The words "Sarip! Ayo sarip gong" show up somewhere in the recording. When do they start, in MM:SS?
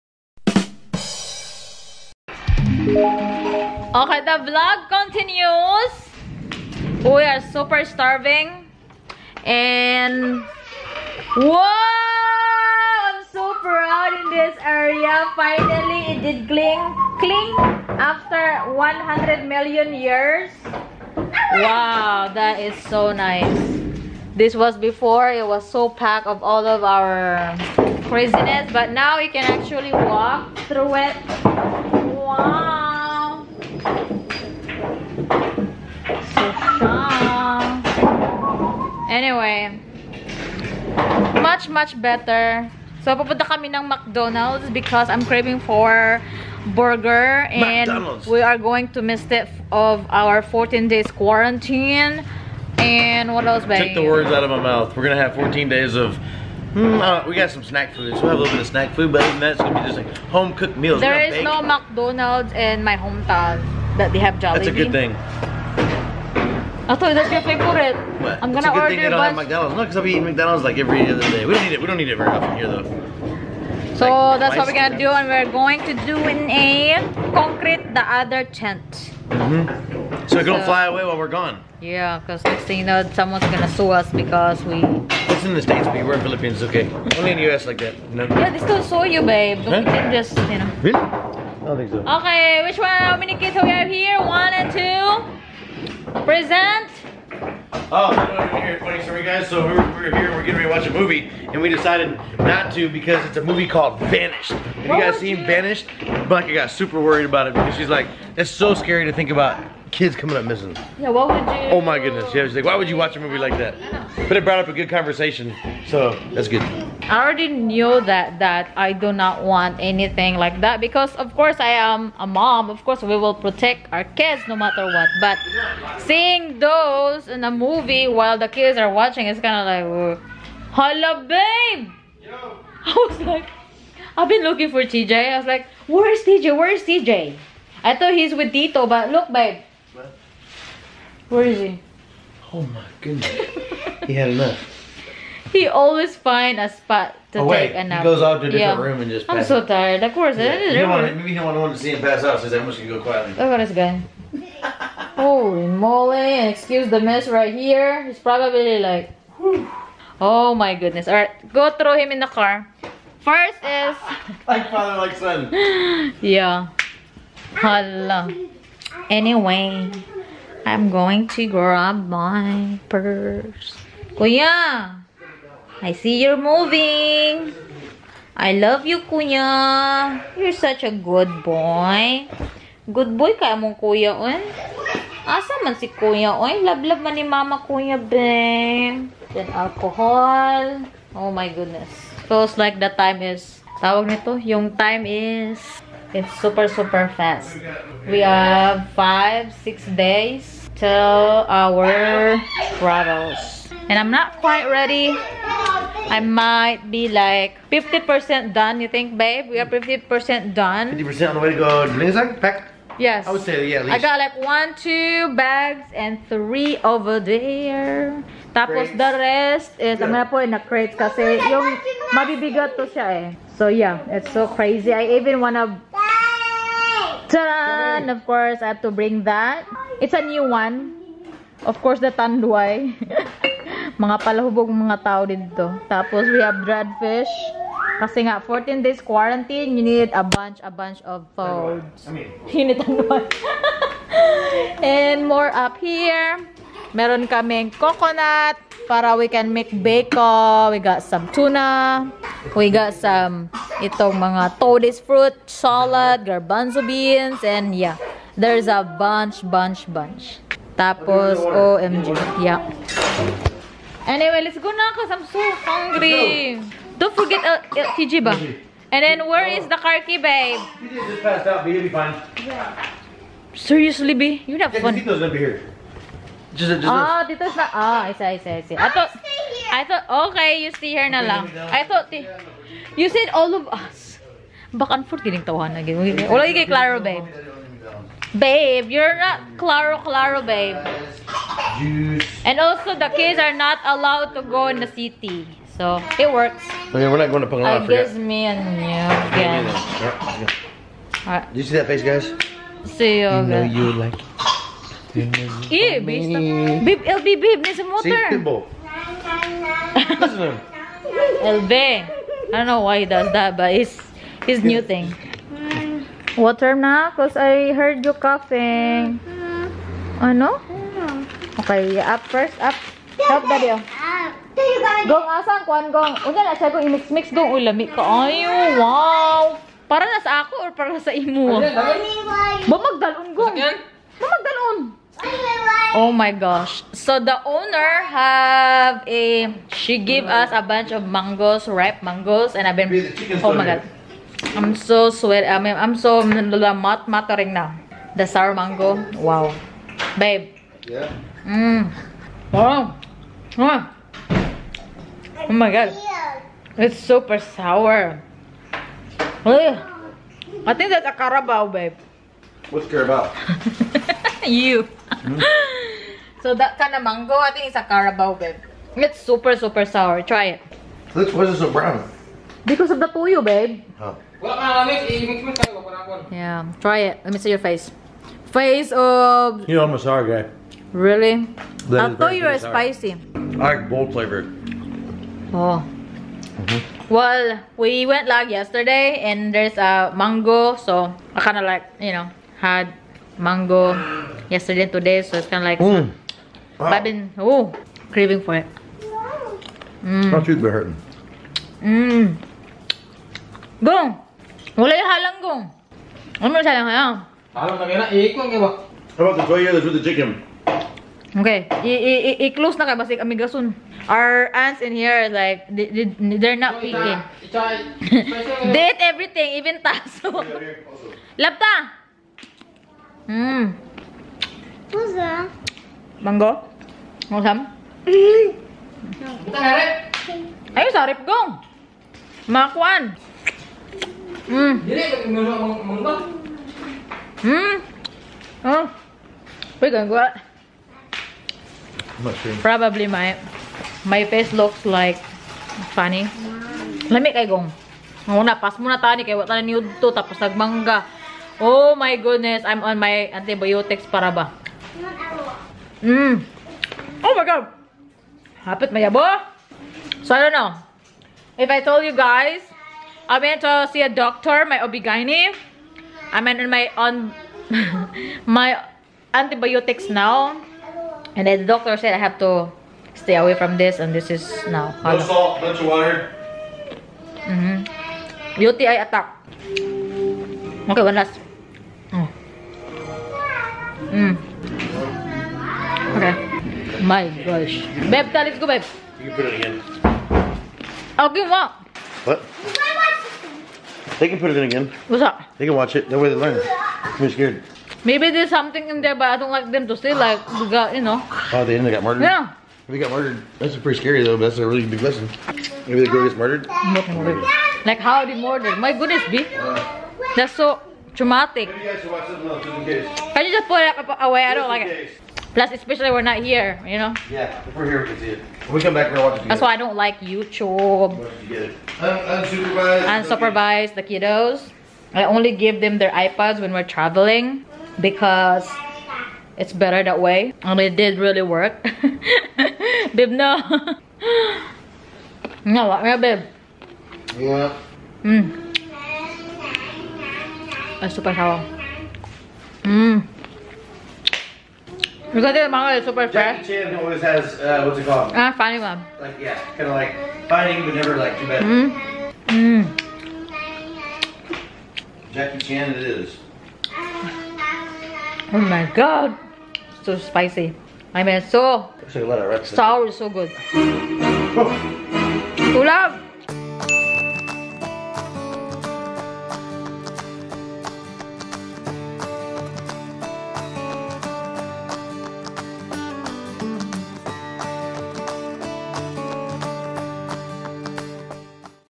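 07:09.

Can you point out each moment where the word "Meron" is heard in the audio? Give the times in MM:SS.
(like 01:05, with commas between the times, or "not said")
04:06.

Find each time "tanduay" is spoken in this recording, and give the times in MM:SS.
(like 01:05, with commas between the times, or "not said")
03:52, 04:02.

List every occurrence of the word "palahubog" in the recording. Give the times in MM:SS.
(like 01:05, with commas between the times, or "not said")
03:54.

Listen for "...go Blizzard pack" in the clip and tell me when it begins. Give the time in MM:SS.
03:31.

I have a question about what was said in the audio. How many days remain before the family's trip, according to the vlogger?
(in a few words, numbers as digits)
5 or 6.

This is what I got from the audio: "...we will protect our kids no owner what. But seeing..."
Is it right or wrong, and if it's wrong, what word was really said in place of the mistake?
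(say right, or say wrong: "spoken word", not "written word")
wrong: "matter", not "owner".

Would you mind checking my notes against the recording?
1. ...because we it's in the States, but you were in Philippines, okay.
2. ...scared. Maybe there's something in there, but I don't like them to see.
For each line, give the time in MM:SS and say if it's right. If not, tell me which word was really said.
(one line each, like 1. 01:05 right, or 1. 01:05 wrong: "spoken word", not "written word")
1. 01:24 right
2. 08:17 right.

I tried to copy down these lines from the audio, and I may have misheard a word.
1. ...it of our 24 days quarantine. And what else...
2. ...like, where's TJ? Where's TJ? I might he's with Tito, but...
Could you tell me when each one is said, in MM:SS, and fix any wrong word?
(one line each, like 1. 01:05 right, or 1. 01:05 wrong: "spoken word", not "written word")
1. 00:49 wrong: "14", not "24"
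2. 02:15 wrong: "thought", not "might".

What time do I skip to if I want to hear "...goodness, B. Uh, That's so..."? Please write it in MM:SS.
08:28.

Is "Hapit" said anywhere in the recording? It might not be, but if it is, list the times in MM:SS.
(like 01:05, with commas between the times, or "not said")
07:38.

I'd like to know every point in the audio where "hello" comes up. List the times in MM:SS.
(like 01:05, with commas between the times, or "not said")
02:10, 02:47.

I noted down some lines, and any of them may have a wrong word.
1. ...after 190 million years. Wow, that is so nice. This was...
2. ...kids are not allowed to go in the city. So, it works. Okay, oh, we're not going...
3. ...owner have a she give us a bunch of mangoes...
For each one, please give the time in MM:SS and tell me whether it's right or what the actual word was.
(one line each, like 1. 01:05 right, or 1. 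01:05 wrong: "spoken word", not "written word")
1. 00:17 wrong: "100", not "190"
2. 04:53 right
3. 05:37 right.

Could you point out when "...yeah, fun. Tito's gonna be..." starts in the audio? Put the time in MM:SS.
04:34.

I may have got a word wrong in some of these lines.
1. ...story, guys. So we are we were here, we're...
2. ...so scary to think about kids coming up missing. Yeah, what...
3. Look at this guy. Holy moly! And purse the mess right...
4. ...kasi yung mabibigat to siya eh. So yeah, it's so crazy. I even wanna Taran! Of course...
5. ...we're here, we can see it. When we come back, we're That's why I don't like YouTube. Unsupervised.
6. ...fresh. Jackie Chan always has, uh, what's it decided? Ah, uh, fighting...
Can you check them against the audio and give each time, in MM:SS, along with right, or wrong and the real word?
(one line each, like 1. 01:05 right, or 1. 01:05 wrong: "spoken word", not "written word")
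1. 01:39 right
2. 01:48 right
3. 02:33 wrong: "excuse", not "purse"
4. 03:40 right
5. 08:37 right
6. 09:06 wrong: "called", not "decided".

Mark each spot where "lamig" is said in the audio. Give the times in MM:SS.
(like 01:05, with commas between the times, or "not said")
05:27, 07:27.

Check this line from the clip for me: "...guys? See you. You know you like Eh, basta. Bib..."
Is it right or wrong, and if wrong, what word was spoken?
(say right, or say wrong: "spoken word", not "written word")
right.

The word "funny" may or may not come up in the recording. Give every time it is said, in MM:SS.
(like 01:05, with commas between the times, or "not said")
01:38, 07:25.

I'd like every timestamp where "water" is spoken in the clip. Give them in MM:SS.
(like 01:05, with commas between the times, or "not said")
05:16, 07:55.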